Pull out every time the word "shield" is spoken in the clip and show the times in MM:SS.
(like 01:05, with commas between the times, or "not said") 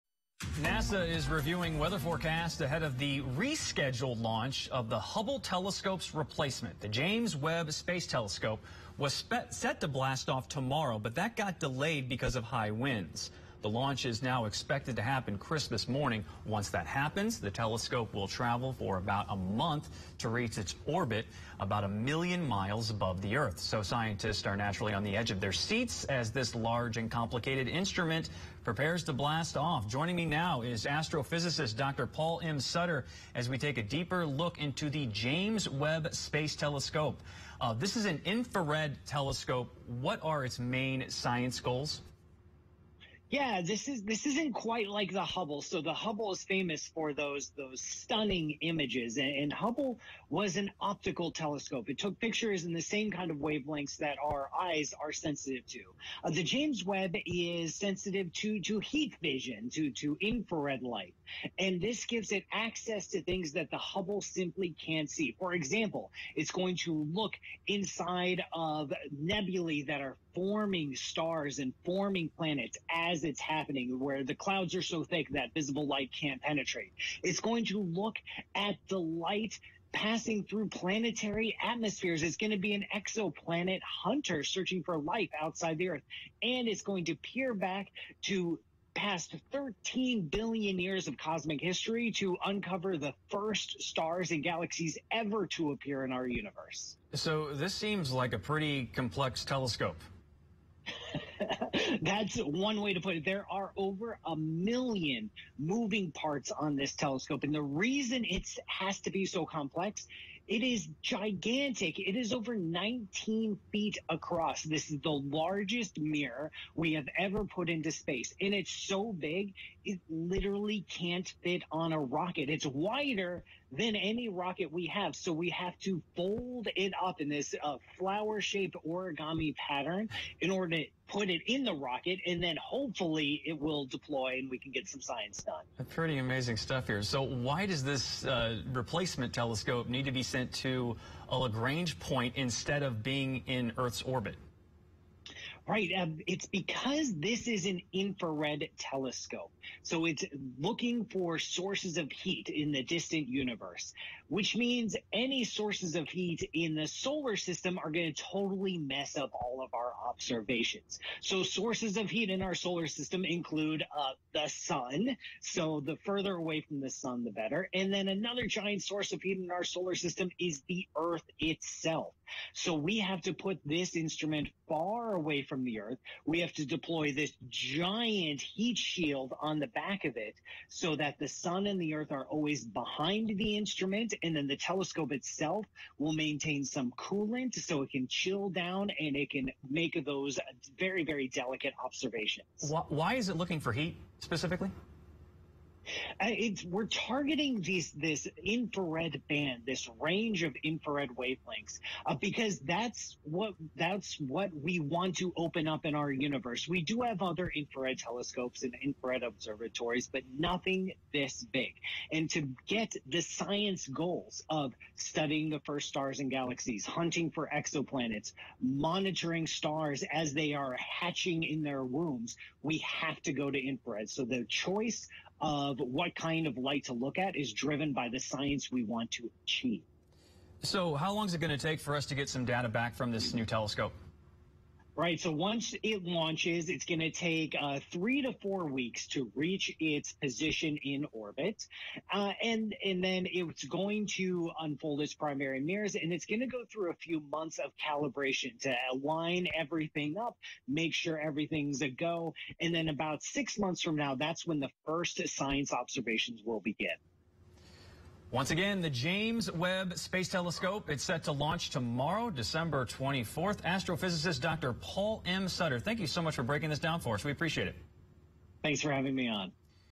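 02:58.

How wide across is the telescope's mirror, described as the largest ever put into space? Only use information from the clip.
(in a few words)
Over 19 feet.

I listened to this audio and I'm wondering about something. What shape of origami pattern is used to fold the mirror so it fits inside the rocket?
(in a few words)
Flower shaped.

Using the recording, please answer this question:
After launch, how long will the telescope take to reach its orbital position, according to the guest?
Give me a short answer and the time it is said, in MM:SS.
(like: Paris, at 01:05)
3 to 4 weeks, at 03:57.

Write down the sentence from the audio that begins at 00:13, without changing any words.
The launch is now expected to happen Christmas morning.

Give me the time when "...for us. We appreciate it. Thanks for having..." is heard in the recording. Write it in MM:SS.
04:27.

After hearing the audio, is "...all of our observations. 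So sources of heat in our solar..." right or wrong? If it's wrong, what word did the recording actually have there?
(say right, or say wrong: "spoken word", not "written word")
right.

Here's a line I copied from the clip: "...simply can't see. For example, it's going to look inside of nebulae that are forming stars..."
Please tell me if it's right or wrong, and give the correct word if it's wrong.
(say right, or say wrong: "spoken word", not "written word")
right.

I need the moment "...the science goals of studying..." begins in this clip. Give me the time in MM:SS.
03:33.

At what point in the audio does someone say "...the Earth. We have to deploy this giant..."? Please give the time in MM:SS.
02:55.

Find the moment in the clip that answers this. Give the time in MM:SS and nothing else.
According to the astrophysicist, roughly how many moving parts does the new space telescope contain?
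01:43.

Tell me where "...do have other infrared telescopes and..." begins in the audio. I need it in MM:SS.
03:26.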